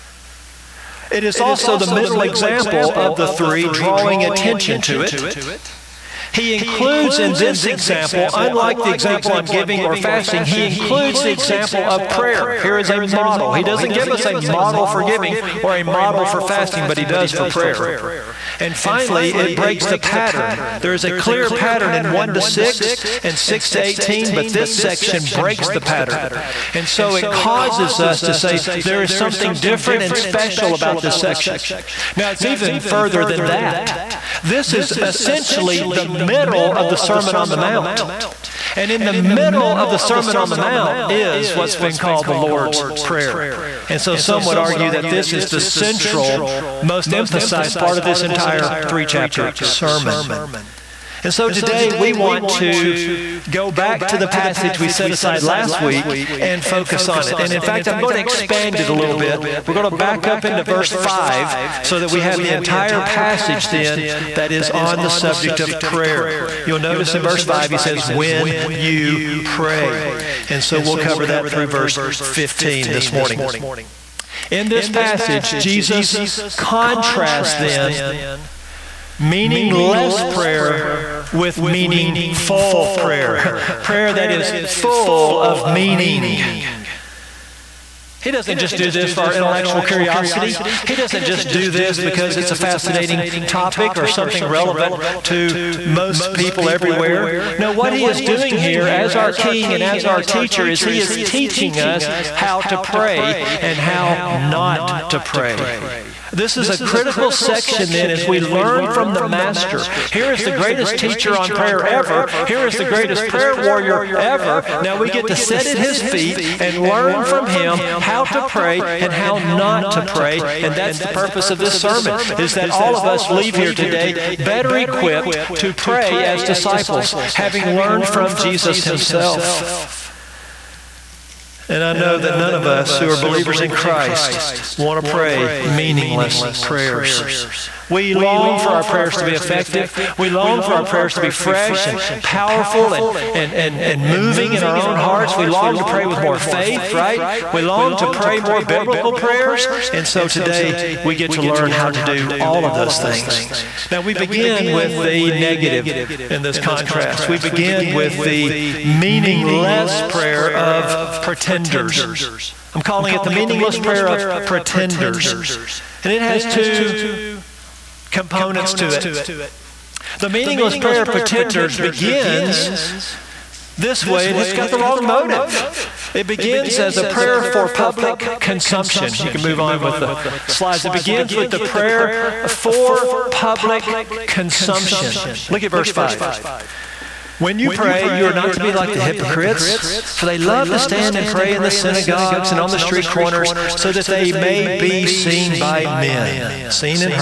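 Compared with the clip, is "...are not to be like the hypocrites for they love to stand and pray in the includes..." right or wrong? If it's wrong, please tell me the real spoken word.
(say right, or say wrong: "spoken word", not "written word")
wrong: "synagogues", not "includes".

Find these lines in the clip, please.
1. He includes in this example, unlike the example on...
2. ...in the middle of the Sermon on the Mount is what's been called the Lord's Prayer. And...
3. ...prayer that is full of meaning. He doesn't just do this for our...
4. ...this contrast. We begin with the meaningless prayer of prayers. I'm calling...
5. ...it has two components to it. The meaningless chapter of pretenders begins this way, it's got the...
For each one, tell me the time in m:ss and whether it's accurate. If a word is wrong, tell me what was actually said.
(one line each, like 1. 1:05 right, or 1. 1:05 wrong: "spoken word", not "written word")
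1. 0:06 right
2. 0:38 right
3. 1:23 right
4. 2:36 wrong: "pretenders", not "prayers"
5. 2:46 wrong: "prayer", not "chapter".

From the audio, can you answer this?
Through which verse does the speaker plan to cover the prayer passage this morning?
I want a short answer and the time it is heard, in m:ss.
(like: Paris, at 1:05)
Verse 15, at 1:11.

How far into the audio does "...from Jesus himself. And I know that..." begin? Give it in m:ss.
2:08.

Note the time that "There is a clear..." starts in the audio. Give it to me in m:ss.
0:20.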